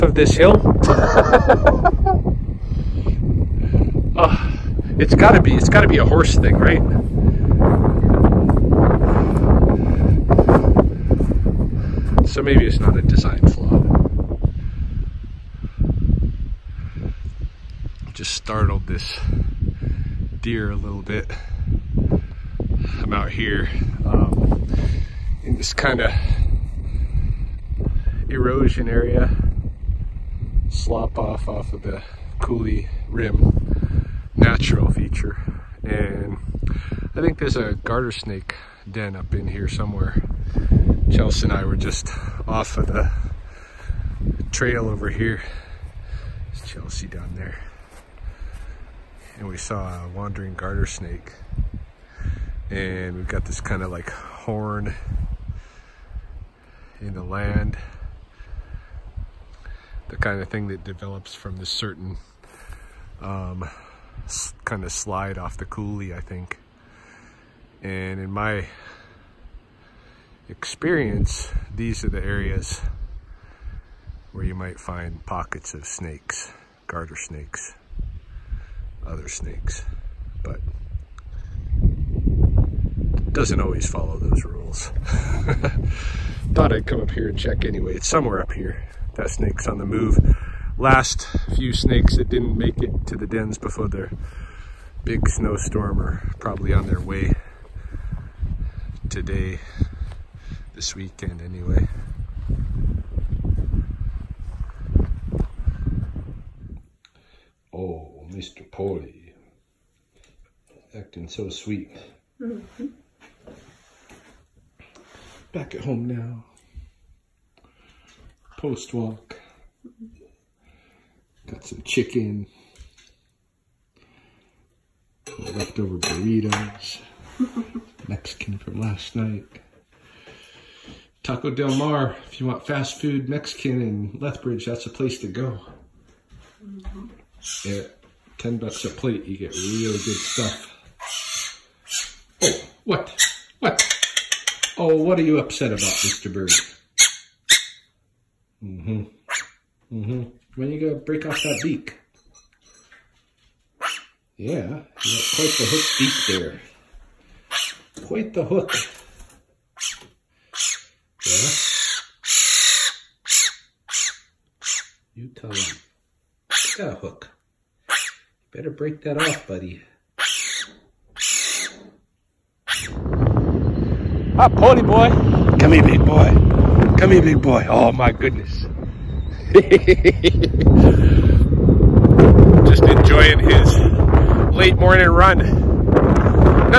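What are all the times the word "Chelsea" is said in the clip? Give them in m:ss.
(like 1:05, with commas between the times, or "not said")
0:41, 0:46.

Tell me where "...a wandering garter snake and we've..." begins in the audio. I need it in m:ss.
0:50.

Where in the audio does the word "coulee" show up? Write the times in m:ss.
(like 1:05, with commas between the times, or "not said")
0:32, 1:05.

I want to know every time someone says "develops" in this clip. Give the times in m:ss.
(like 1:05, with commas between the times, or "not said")
1:00.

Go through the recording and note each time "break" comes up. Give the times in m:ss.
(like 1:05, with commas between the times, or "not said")
2:31, 2:48.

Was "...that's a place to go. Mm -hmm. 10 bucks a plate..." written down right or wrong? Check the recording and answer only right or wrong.
right.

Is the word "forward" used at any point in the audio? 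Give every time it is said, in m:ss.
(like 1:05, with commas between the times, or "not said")
not said.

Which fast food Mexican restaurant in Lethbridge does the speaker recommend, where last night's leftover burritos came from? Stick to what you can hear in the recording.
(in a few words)
Taco Del Mar.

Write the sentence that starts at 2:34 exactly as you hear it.
Yeah, quite the hook beak there.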